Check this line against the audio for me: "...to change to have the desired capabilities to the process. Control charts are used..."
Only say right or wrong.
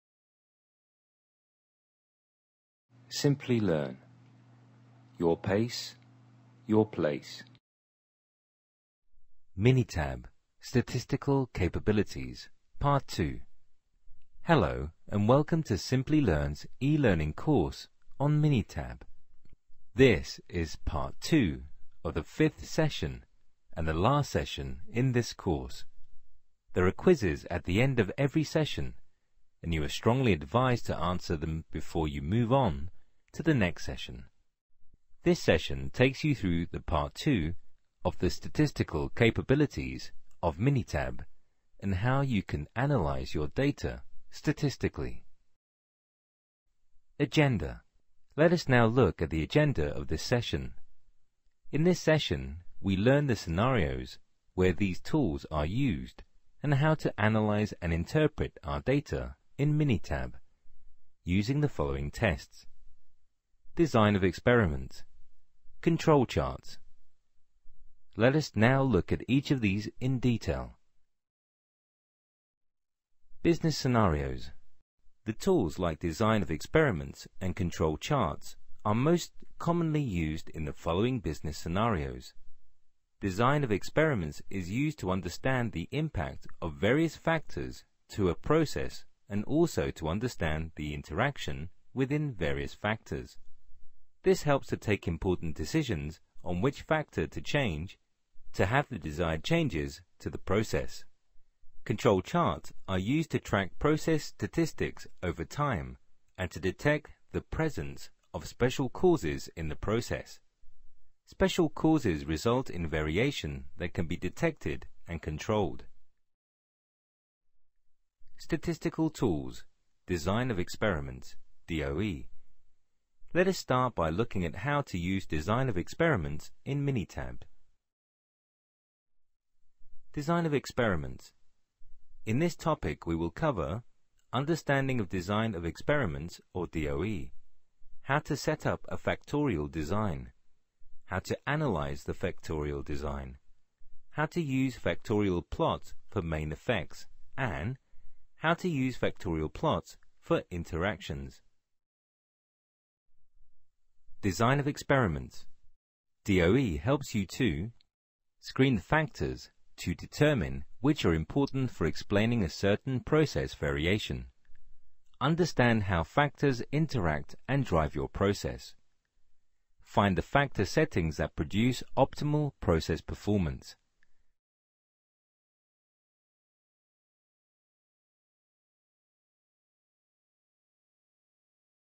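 wrong.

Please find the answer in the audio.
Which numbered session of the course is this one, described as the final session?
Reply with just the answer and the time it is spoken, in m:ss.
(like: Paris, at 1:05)
fifth, at 0:22.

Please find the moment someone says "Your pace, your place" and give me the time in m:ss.
0:05.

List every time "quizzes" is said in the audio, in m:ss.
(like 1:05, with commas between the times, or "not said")
0:26.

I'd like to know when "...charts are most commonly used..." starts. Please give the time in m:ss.
1:17.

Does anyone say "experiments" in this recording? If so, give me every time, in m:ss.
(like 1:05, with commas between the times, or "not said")
1:04, 1:16, 1:23, 2:00, 2:05, 2:10, 2:15, 2:34.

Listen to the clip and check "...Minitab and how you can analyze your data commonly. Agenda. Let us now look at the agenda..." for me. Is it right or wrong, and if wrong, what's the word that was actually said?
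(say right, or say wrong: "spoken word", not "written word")
wrong: "statistically", not "commonly".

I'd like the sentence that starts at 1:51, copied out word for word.
Special causes result in variation that can be detected and controlled.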